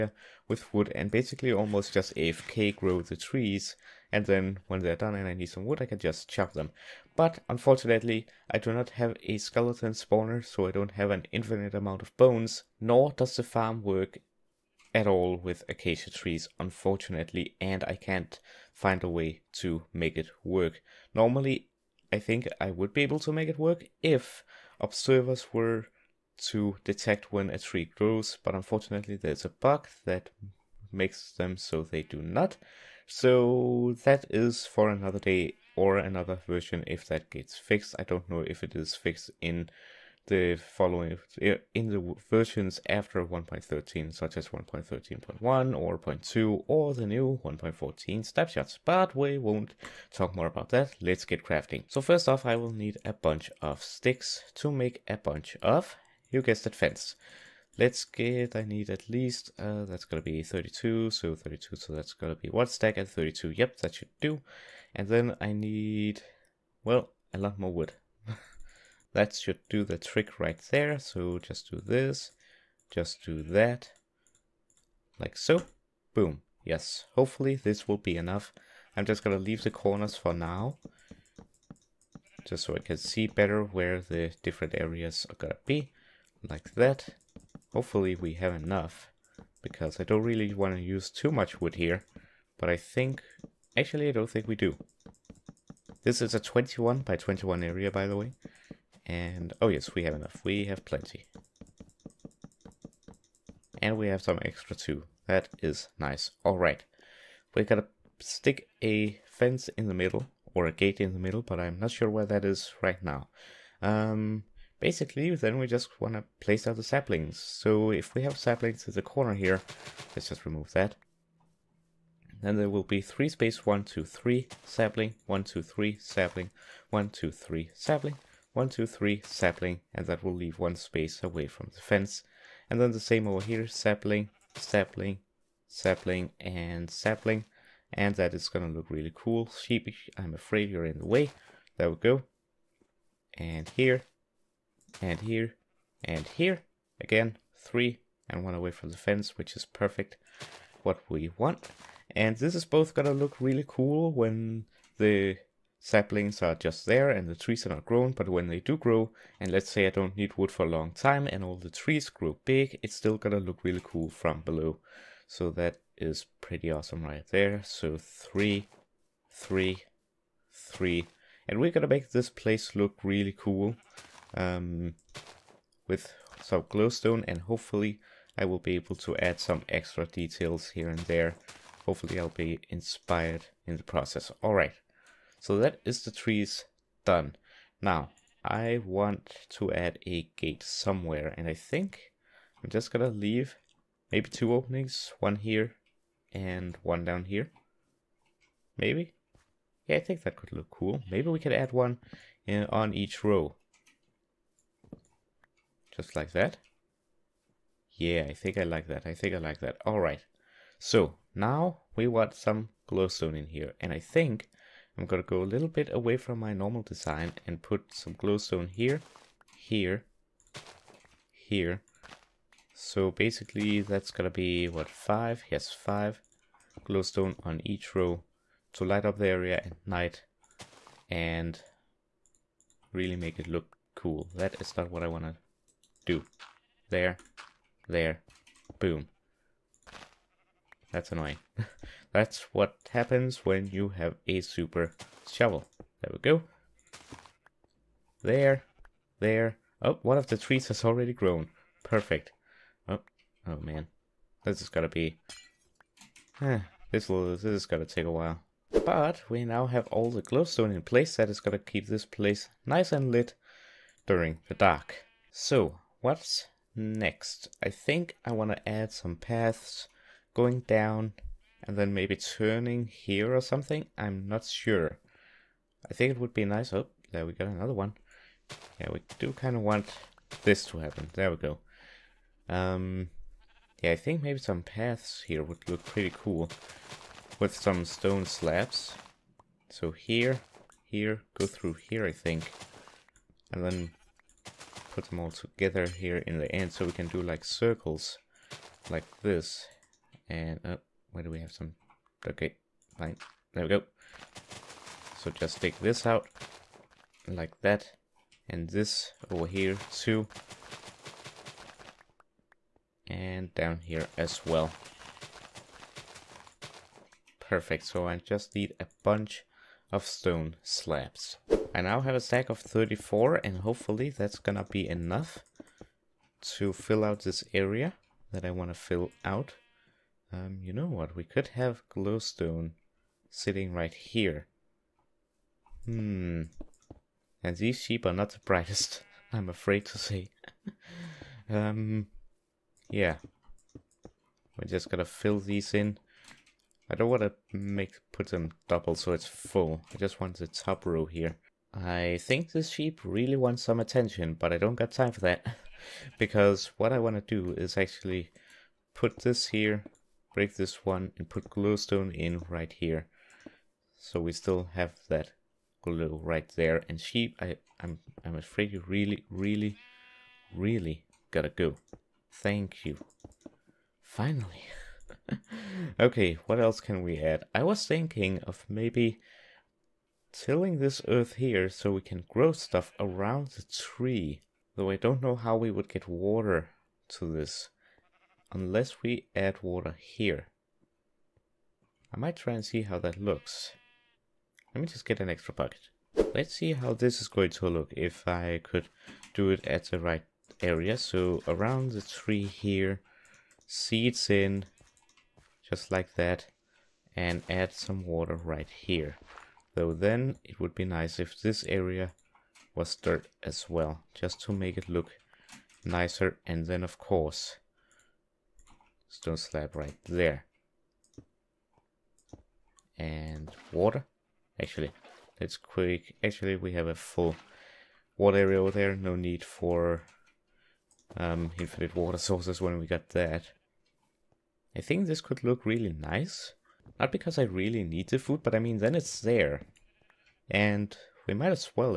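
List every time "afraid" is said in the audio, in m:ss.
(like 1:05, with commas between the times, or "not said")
2:20, 5:39, 6:08.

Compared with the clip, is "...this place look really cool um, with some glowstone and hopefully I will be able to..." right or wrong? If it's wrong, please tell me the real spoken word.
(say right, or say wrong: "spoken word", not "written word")
right.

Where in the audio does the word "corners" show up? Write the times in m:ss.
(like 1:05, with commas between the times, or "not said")
1:19, 1:59.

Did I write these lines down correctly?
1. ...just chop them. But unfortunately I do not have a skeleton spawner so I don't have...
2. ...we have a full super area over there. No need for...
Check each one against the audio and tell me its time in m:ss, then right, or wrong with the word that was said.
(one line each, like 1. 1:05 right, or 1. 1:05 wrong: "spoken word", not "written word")
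1. 0:05 right
2. 7:06 wrong: "water", not "super".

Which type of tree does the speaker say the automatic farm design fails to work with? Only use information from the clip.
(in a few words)
Acacia.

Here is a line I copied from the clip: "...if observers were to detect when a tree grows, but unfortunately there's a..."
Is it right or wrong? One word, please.
right.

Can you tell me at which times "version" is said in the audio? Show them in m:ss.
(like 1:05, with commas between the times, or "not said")
0:36, 0:42.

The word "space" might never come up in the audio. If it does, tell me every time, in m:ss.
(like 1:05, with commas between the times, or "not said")
2:03, 2:10.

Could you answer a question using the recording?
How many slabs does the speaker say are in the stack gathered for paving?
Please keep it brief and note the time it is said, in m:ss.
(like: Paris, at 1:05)
34, at 5:22.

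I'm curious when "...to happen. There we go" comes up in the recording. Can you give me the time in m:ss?
4:40.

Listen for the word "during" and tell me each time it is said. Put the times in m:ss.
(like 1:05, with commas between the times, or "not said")
4:24.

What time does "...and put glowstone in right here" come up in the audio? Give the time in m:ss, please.
6:01.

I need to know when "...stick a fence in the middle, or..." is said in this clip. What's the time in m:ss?
1:48.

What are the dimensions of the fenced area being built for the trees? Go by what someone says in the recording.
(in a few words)
21 by 21.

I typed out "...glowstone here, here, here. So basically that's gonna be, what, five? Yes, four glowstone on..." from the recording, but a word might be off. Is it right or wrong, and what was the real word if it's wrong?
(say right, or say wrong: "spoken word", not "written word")
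wrong: "five", not "four".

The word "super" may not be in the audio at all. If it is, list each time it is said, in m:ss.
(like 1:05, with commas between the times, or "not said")
4:04.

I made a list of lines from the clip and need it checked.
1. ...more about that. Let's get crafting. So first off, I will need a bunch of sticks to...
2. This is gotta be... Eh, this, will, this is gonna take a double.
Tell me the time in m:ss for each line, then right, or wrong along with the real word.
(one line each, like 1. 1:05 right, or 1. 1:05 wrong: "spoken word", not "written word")
1. 0:50 right
2. 4:14 wrong: "while", not "double".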